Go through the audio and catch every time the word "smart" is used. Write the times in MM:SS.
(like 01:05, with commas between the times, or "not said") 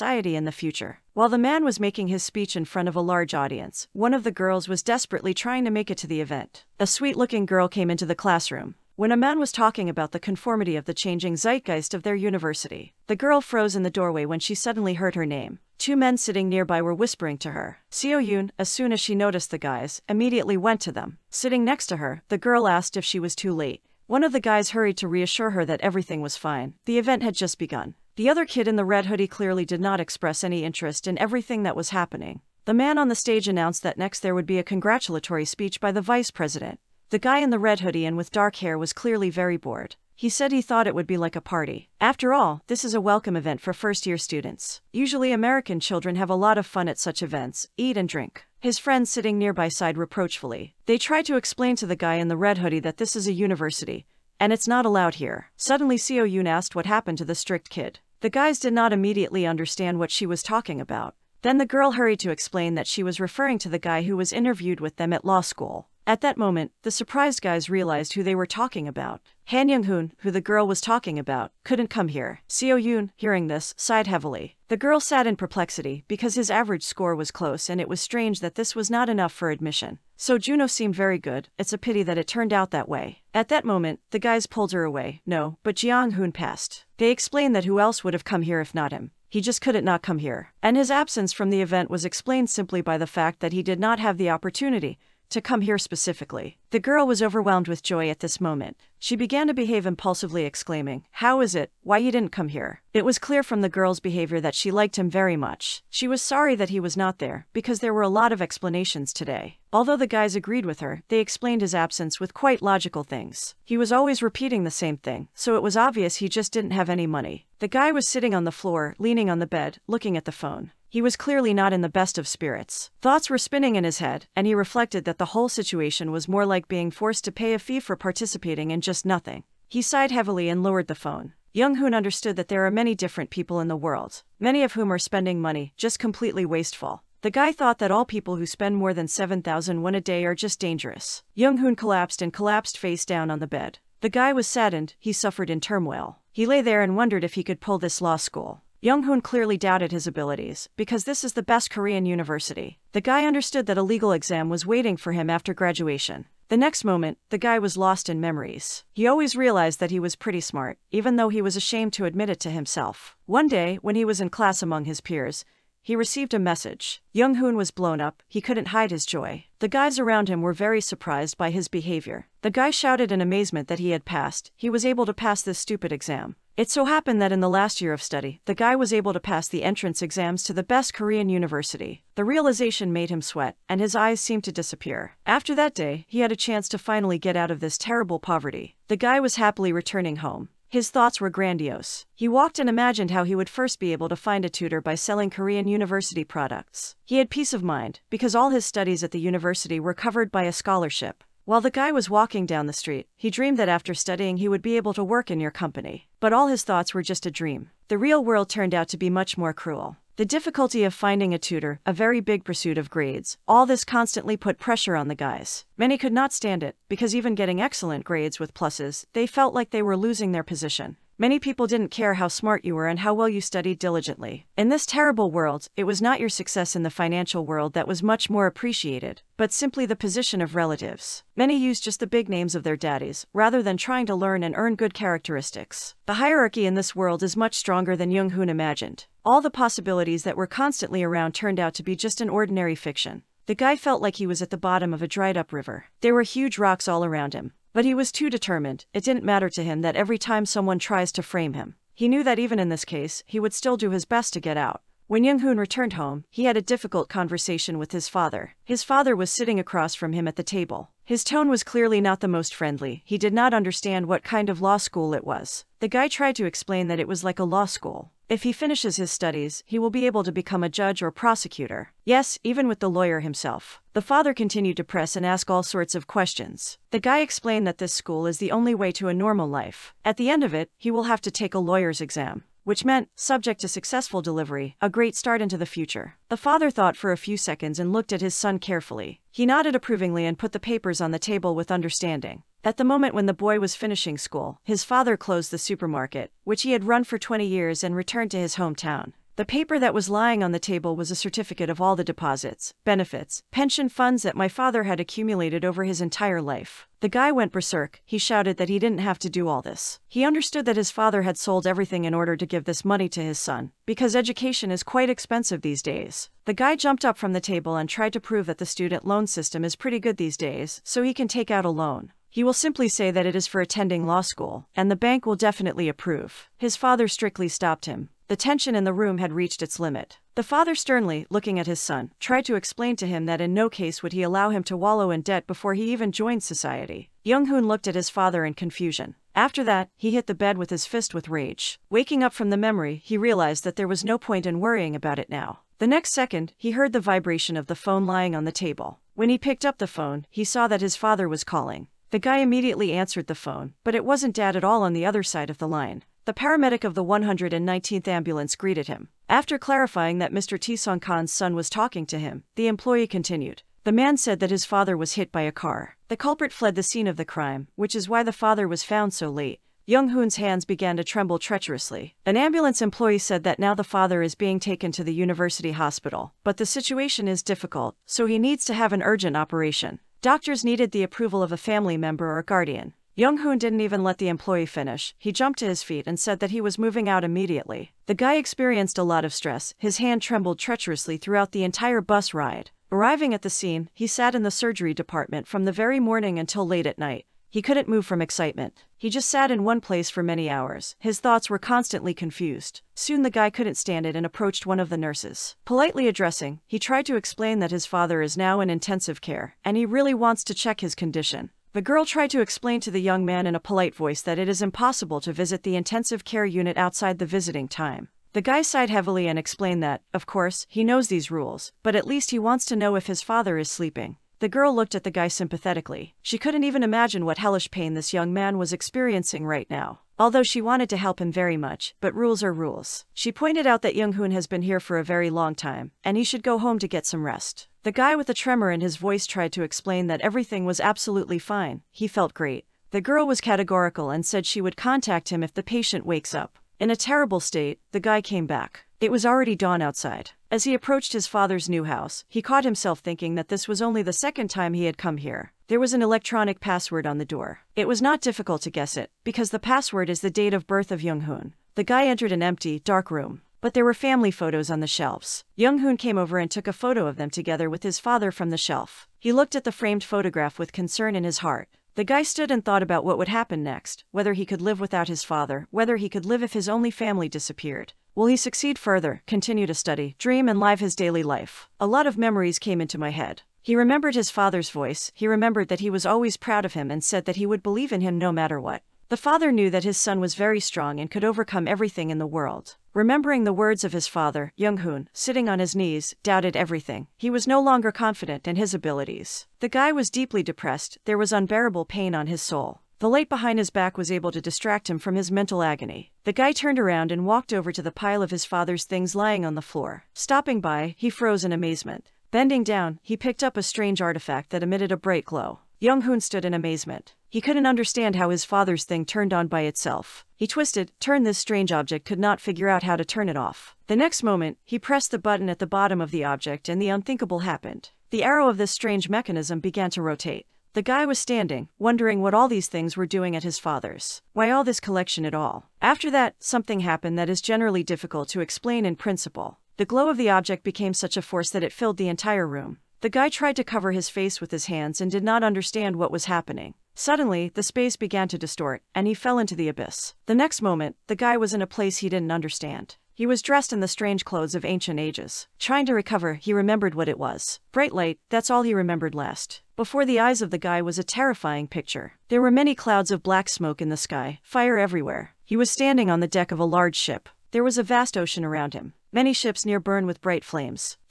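02:40, 03:42.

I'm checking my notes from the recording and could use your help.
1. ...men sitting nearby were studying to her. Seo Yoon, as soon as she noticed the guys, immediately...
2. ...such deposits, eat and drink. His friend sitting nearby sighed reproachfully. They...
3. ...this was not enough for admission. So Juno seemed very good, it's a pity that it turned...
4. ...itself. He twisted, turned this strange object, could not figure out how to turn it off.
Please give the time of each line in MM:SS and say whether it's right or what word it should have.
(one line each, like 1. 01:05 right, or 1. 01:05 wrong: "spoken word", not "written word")
1. 00:15 wrong: "whispering", not "studying"
2. 00:46 wrong: "events", not "deposits"
3. 01:18 right
4. 08:39 right.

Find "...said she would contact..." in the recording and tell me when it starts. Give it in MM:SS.
07:24.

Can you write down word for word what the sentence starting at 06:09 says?
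Young Hoon's hands began to tremble treacherously.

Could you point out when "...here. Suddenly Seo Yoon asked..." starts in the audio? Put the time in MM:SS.
00:55.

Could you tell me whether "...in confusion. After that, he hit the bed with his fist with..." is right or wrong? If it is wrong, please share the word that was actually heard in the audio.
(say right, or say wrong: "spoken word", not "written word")
right.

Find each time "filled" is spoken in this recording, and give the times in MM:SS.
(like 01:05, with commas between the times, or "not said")
09:01.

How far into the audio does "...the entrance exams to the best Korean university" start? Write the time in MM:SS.
02:59.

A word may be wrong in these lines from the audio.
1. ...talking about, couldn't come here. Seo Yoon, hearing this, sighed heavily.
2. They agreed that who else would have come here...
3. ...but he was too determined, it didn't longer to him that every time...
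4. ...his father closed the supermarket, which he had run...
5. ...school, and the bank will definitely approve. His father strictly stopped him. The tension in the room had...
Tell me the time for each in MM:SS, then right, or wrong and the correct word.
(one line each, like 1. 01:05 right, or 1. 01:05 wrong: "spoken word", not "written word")
1. 01:10 right
2. 01:26 wrong: "explained", not "agreed"
3. 04:07 wrong: "matter", not "longer"
4. 04:54 right
5. 05:24 right.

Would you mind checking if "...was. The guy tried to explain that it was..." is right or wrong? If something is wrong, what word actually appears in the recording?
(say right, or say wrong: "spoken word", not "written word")
right.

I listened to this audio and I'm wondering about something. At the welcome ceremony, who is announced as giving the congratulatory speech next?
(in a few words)
the vice president.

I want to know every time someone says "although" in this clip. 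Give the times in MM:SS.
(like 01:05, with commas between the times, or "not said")
01:49, 07:10.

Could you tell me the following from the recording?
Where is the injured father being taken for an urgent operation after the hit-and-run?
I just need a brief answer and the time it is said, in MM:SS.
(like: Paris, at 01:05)
university hospital, at 06:15.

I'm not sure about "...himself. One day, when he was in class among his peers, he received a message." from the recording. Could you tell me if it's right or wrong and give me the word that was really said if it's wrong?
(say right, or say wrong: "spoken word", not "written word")
right.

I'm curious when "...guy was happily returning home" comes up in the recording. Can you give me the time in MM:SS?
03:08.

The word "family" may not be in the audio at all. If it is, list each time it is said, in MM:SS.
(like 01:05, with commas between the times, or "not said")
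06:21, 07:43, 07:56.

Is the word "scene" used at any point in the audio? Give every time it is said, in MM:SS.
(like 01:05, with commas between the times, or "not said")
06:06, 06:33.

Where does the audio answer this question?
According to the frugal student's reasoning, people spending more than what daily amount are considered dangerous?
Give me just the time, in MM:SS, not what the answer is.
02:19.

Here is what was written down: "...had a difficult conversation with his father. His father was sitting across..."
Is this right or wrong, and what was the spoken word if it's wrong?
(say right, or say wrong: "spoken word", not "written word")
right.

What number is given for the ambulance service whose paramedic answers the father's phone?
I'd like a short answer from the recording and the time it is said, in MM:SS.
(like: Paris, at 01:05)
119, at 05:57.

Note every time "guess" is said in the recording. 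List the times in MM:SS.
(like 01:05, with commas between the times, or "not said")
07:38.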